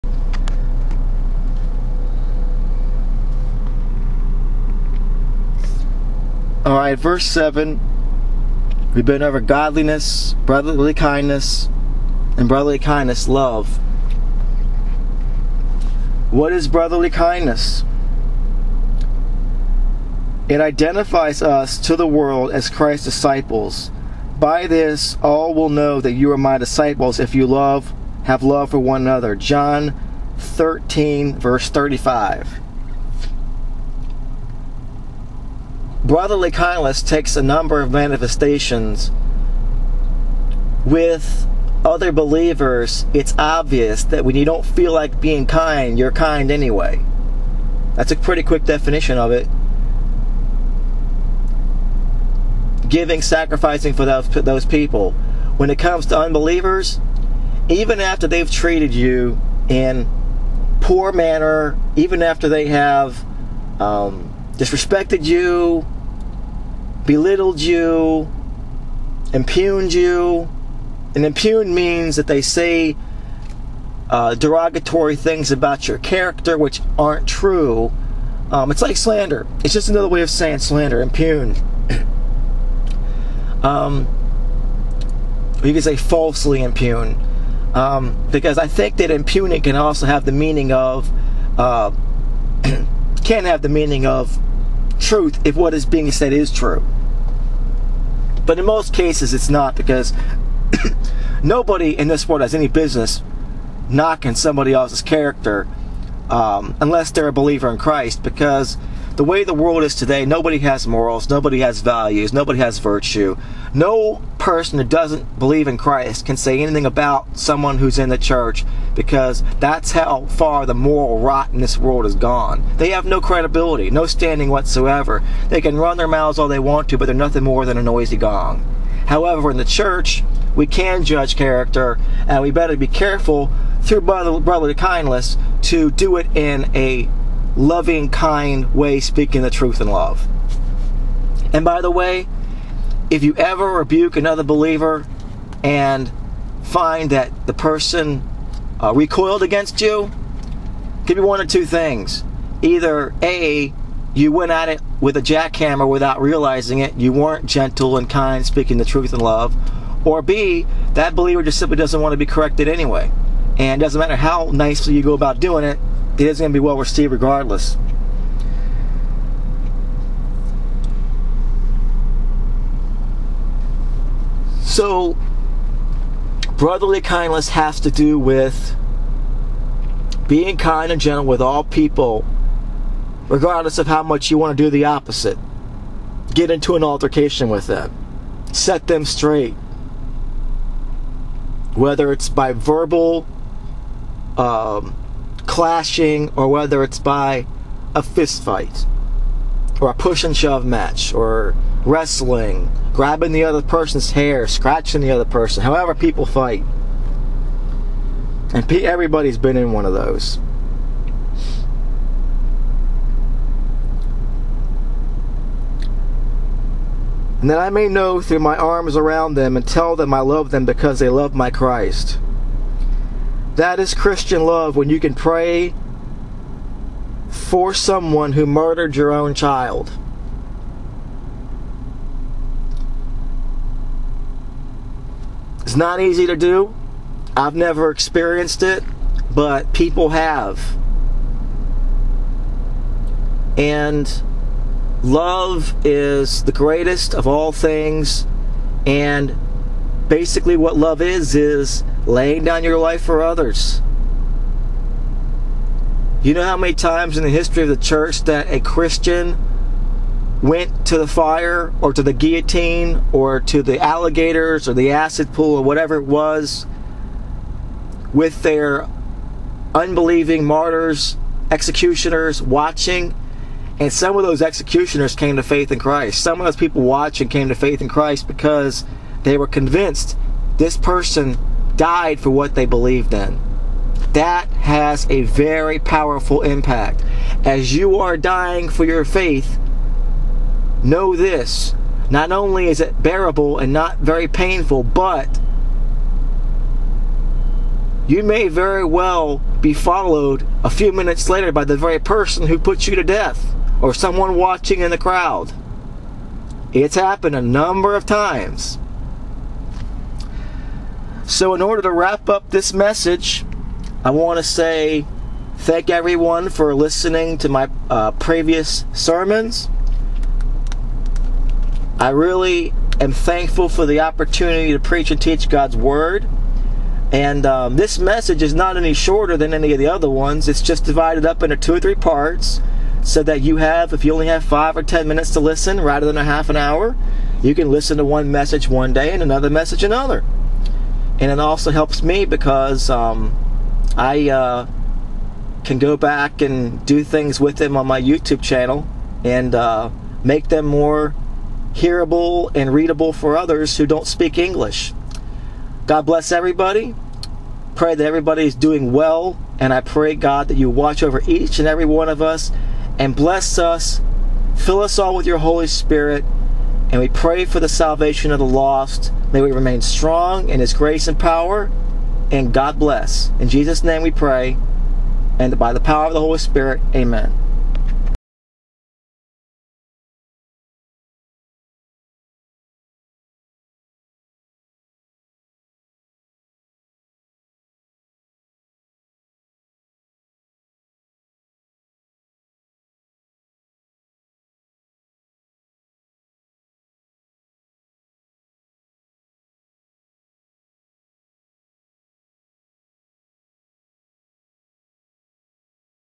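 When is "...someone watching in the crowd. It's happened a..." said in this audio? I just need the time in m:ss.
5:03.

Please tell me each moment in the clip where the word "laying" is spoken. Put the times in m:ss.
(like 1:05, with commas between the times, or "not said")
4:12.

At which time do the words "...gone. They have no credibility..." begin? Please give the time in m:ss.
2:02.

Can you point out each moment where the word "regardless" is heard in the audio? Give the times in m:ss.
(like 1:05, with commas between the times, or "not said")
2:47, 3:03.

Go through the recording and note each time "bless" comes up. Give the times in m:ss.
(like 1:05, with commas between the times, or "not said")
5:56, 6:03, 6:12.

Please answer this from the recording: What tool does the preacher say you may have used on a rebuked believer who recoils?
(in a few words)
a jackhammer.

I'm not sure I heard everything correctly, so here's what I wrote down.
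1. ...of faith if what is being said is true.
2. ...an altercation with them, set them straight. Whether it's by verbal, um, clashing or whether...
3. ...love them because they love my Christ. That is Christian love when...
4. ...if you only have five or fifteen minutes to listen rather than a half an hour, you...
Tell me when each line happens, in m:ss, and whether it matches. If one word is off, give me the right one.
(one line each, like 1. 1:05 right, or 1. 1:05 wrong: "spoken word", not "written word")
1. 1:34 wrong: "truth", not "faith"
2. 3:06 right
3. 3:40 right
4. 5:33 wrong: "ten", not "fifteen".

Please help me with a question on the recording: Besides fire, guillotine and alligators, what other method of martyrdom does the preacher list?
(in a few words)
acid pool.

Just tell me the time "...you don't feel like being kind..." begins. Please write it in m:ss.
0:44.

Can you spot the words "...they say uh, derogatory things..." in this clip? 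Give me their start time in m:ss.
1:12.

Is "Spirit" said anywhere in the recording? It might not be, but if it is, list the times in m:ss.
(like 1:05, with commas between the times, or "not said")
6:05, 6:16.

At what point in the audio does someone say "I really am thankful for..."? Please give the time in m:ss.
5:21.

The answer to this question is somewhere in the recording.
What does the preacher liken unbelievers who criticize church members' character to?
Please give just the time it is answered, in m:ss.
2:07.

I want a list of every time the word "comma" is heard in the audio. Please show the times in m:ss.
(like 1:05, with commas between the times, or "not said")
not said.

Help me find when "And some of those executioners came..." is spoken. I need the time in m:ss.
4:33.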